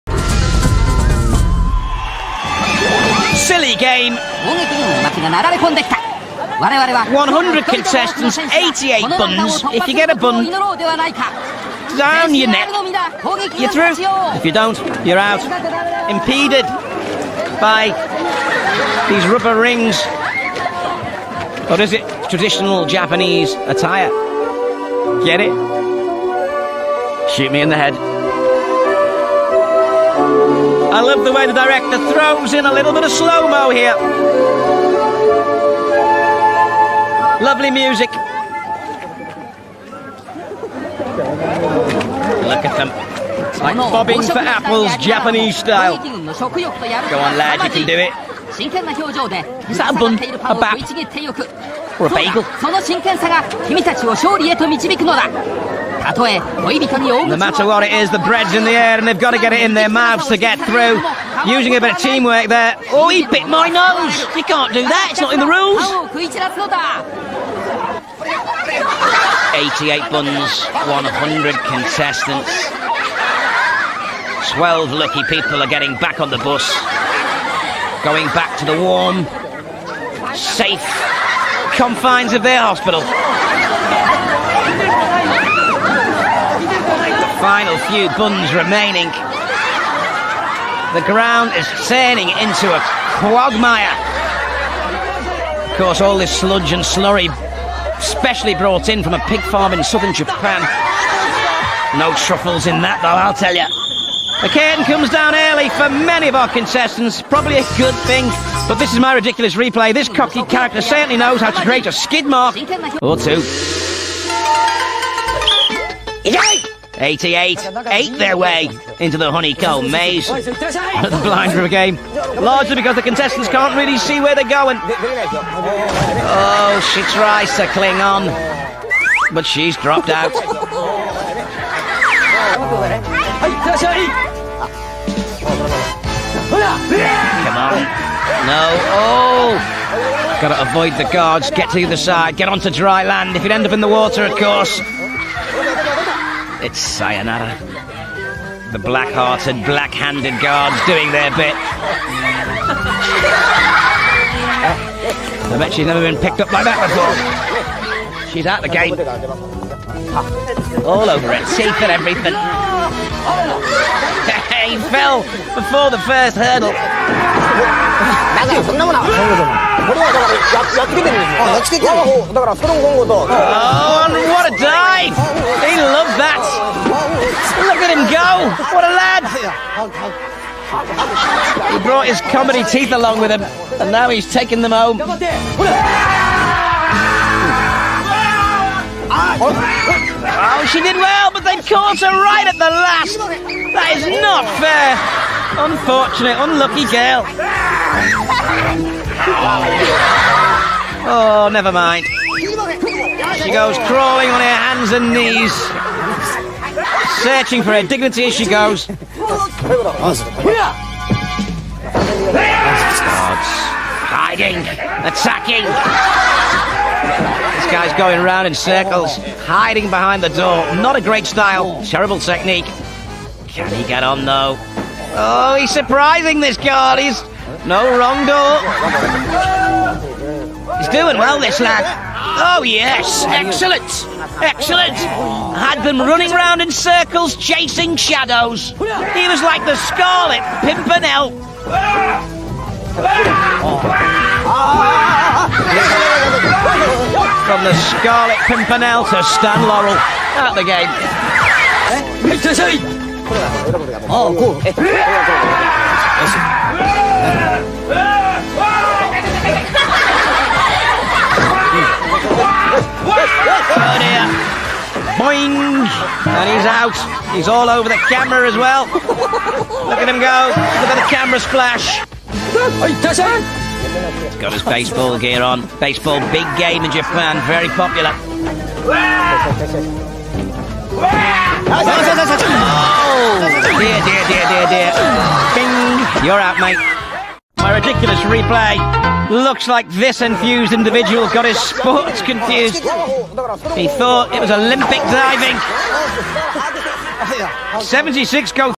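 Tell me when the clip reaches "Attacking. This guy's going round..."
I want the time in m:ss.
3:34.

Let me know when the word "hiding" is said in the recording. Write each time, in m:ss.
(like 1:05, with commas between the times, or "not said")
3:34, 3:39.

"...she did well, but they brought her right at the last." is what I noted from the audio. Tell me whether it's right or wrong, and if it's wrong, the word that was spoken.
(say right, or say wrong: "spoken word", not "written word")
wrong: "caught", not "brought".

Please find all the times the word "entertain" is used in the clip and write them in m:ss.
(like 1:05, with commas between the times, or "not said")
not said.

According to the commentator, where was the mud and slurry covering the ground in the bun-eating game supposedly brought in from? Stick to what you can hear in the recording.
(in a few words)
A pig farm.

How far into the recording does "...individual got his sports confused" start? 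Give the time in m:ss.
4:50.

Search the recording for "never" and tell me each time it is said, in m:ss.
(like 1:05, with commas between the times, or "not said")
2:35, 3:21.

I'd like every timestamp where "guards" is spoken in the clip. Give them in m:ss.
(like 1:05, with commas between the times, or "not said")
2:21, 2:30, 3:46.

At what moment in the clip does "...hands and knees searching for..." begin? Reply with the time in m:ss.
3:24.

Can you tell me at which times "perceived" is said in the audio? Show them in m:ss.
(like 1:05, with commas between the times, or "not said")
not said.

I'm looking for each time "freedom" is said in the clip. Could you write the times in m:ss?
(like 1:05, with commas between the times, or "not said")
not said.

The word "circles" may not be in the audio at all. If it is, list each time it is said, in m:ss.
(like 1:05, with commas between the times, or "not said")
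3:38, 3:56.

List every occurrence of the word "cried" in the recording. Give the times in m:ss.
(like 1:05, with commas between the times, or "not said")
not said.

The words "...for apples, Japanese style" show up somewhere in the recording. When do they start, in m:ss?
0:44.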